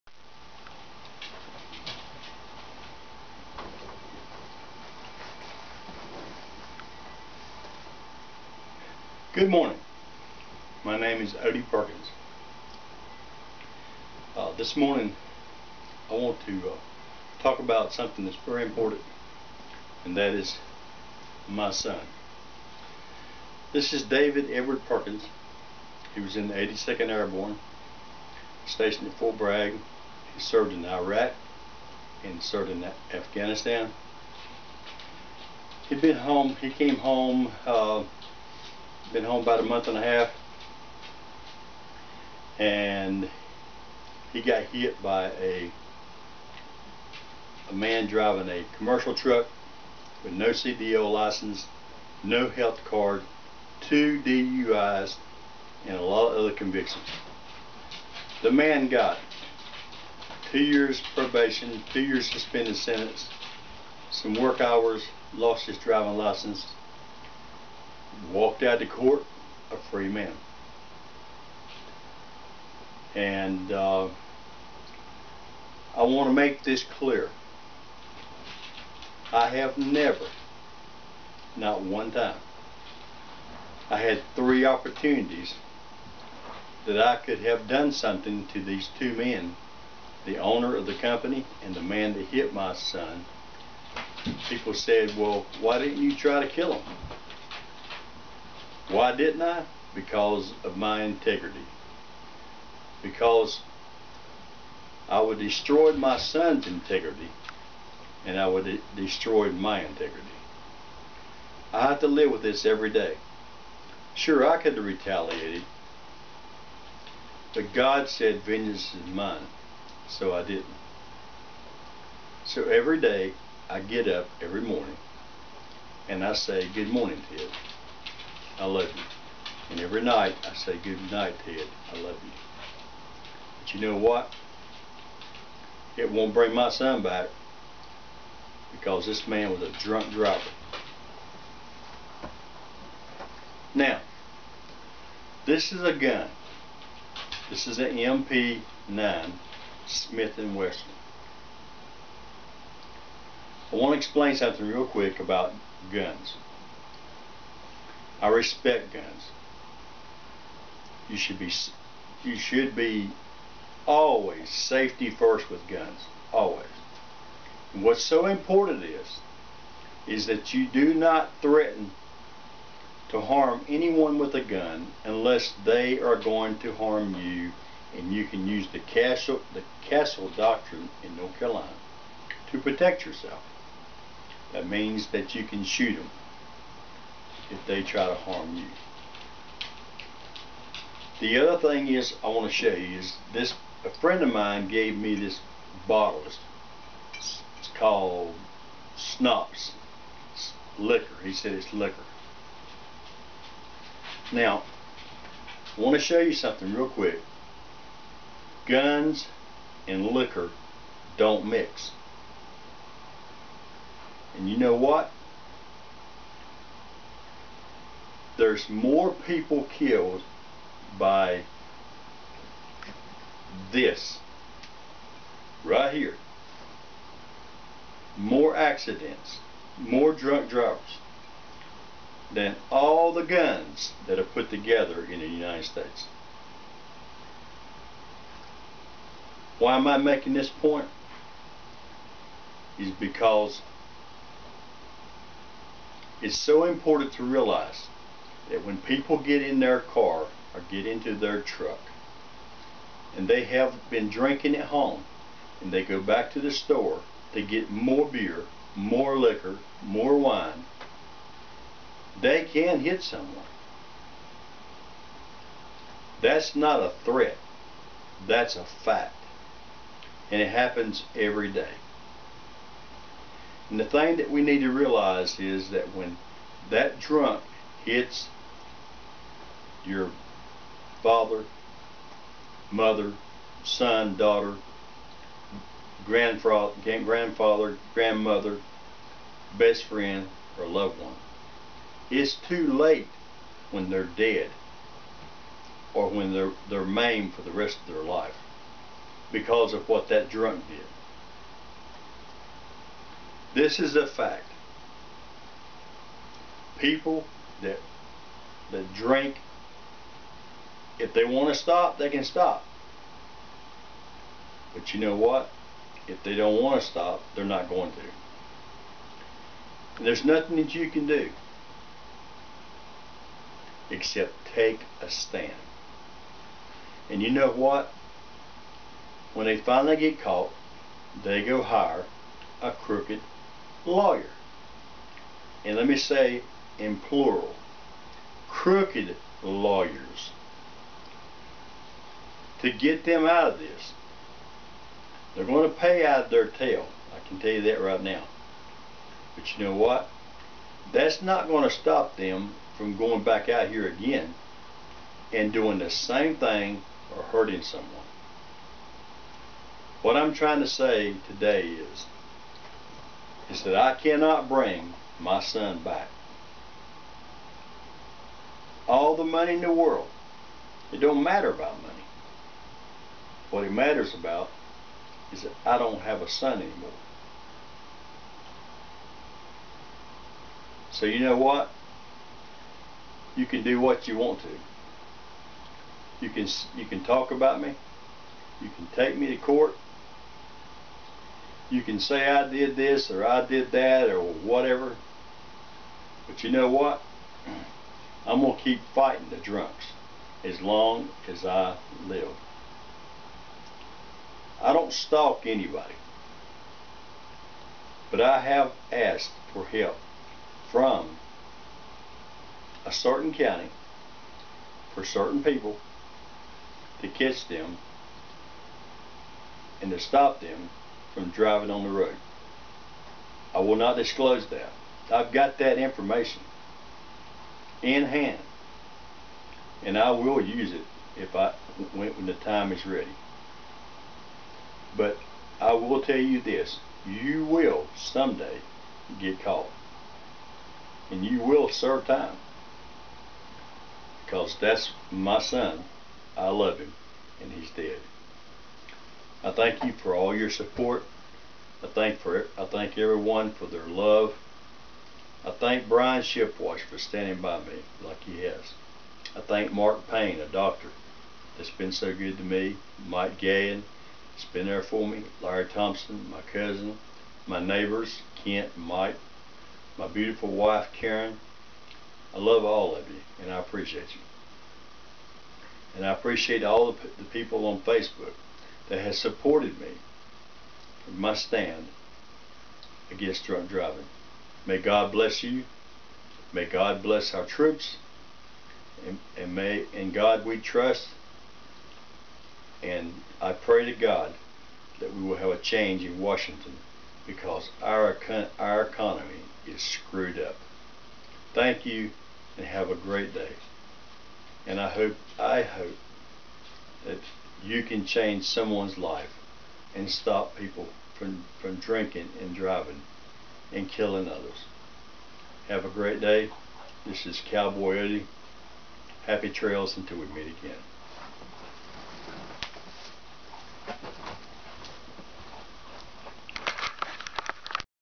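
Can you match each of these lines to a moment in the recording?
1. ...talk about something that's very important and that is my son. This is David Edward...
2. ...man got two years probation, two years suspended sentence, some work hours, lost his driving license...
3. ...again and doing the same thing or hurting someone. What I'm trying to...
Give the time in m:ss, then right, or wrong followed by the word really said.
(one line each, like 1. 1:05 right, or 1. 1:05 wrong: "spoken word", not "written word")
1. 0:17 right
2. 0:58 right
3. 5:53 right.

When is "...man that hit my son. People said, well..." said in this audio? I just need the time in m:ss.
1:31.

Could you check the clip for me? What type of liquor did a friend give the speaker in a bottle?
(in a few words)
Schnapps.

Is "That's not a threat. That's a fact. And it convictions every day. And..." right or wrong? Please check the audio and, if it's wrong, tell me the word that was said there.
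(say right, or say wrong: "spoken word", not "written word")
wrong: "happens", not "convictions".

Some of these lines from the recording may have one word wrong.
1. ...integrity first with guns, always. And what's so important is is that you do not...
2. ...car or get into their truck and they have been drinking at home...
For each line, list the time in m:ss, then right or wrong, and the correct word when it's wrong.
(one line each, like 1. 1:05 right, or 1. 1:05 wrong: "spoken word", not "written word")
1. 2:44 wrong: "safety", not "integrity"
2. 4:09 right.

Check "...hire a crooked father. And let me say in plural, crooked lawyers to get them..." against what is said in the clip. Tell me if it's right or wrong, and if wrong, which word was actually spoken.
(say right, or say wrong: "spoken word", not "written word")
wrong: "lawyer", not "father".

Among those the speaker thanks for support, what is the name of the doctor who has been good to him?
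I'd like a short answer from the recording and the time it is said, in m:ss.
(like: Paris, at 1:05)
Mark Payne, at 7:39.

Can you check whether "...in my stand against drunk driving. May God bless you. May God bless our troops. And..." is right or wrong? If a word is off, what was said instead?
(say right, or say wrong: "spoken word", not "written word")
right.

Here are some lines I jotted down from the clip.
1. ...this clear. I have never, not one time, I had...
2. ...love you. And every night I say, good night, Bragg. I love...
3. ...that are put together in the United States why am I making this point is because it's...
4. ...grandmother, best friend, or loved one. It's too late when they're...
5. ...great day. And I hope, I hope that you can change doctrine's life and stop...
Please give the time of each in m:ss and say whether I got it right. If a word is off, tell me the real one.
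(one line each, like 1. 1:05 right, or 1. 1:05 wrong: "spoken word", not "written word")
1. 1:16 right
2. 2:08 wrong: "Ted", not "Bragg"
3. 3:54 right
4. 4:47 right
5. 8:22 wrong: "someone", not "doctrine".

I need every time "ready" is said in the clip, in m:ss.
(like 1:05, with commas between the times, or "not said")
7:12.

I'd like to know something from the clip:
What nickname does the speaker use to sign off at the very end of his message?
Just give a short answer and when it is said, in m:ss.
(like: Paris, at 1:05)
Cowboy Eddie, at 8:37.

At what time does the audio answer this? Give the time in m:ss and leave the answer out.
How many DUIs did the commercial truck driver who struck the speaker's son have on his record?
0:53.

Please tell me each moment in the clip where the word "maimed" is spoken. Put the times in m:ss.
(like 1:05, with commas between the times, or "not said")
4:56.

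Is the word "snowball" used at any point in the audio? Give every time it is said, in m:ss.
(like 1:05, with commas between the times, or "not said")
not said.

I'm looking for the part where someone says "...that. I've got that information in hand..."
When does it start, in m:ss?
7:04.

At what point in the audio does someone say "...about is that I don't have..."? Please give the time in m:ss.
6:14.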